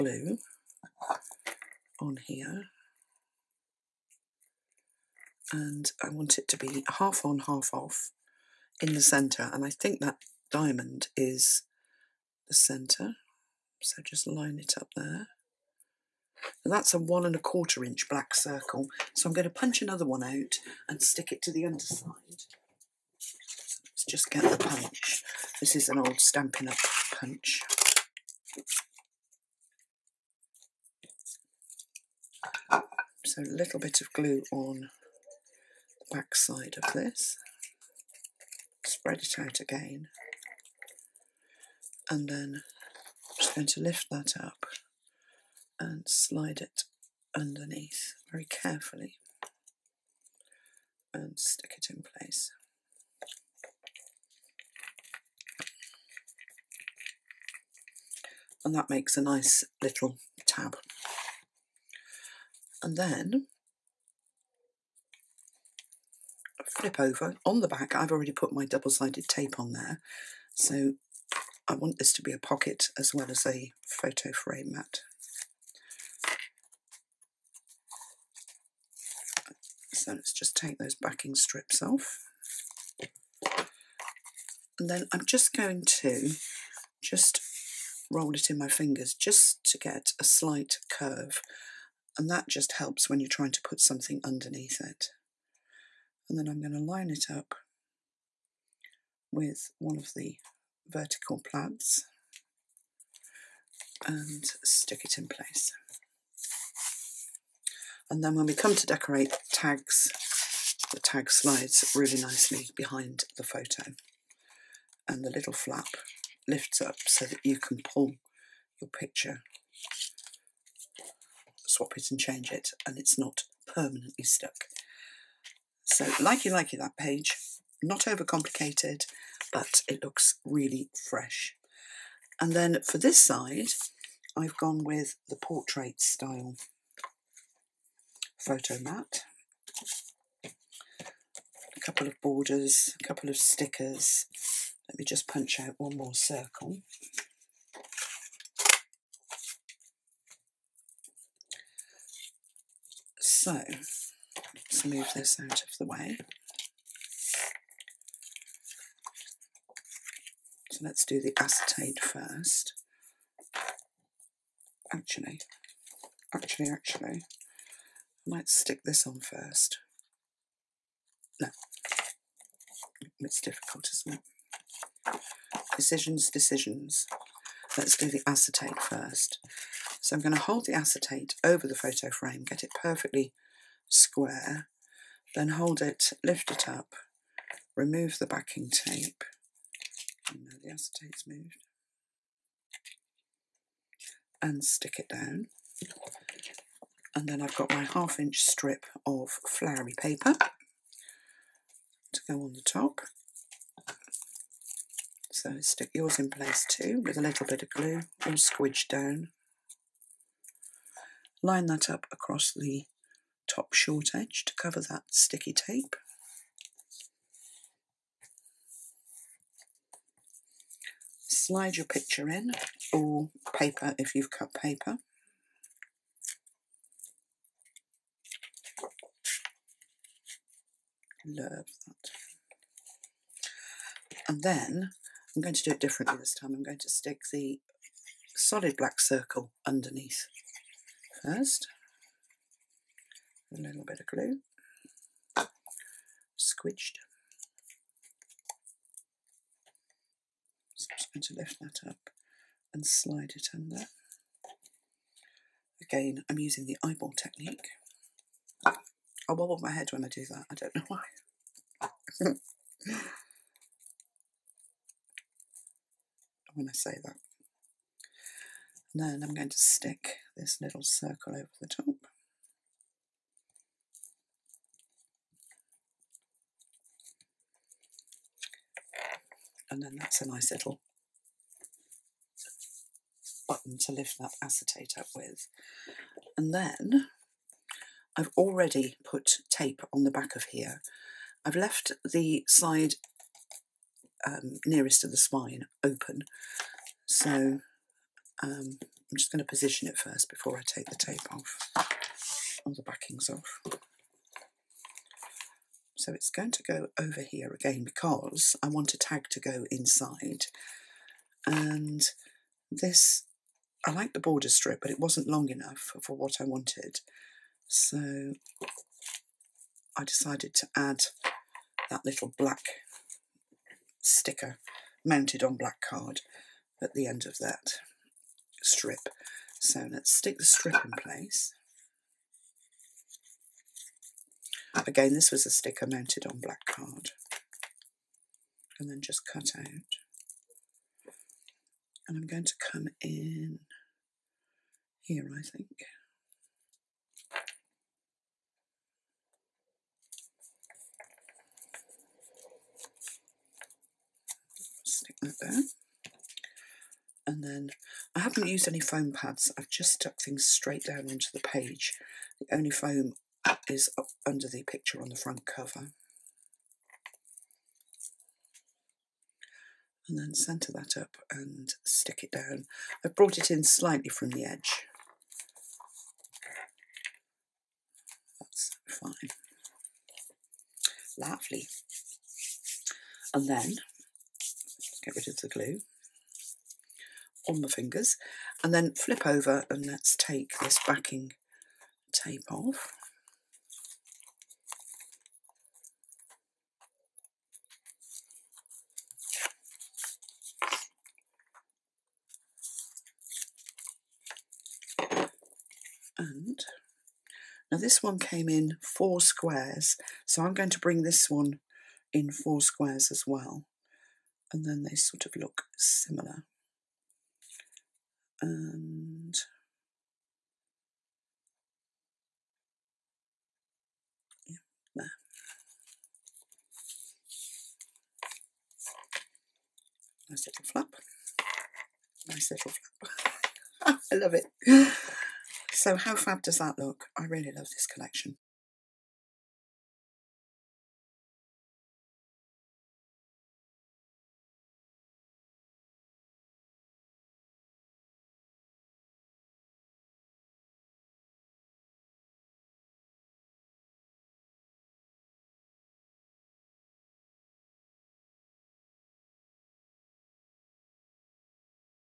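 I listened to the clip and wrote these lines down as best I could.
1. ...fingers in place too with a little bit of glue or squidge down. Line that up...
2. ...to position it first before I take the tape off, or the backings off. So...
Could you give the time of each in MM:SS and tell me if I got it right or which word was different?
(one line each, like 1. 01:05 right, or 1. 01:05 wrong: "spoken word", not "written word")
1. 03:25 wrong: "yours", not "fingers"
2. 04:59 right.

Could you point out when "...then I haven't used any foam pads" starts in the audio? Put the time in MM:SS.
05:57.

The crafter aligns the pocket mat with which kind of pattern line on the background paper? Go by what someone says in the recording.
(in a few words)
vertical plaids.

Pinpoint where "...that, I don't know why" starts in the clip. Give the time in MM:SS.
04:20.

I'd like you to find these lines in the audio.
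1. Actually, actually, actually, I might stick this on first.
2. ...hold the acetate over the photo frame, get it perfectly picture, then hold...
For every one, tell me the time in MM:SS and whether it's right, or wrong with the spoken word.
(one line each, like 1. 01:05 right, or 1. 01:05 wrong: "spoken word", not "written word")
1. 02:44 right
2. 03:00 wrong: "square", not "picture".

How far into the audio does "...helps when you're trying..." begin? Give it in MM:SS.
01:32.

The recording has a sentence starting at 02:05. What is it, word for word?
So likey likey that page, not overcomplicated, but it looks really fresh.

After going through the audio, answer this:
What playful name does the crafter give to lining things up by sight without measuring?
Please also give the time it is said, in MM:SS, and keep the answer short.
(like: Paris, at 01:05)
eyeball technique, at 04:16.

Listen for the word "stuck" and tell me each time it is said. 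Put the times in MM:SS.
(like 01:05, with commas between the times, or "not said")
02:04, 05:59.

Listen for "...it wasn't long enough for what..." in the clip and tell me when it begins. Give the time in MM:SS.
05:14.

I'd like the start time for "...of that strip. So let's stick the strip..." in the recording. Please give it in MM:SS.
05:27.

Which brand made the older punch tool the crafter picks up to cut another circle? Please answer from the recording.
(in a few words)
Stampin' Up.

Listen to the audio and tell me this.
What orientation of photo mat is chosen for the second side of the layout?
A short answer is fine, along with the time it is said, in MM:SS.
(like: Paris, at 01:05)
portrait, at 02:15.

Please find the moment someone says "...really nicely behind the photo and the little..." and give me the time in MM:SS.
01:51.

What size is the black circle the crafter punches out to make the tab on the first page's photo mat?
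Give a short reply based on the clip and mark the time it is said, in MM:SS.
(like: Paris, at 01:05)
1 1/4 inch, at 00:16.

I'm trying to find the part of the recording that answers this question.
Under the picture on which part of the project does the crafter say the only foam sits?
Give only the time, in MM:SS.
06:05.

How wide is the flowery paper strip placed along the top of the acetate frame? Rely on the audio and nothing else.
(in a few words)
half inch.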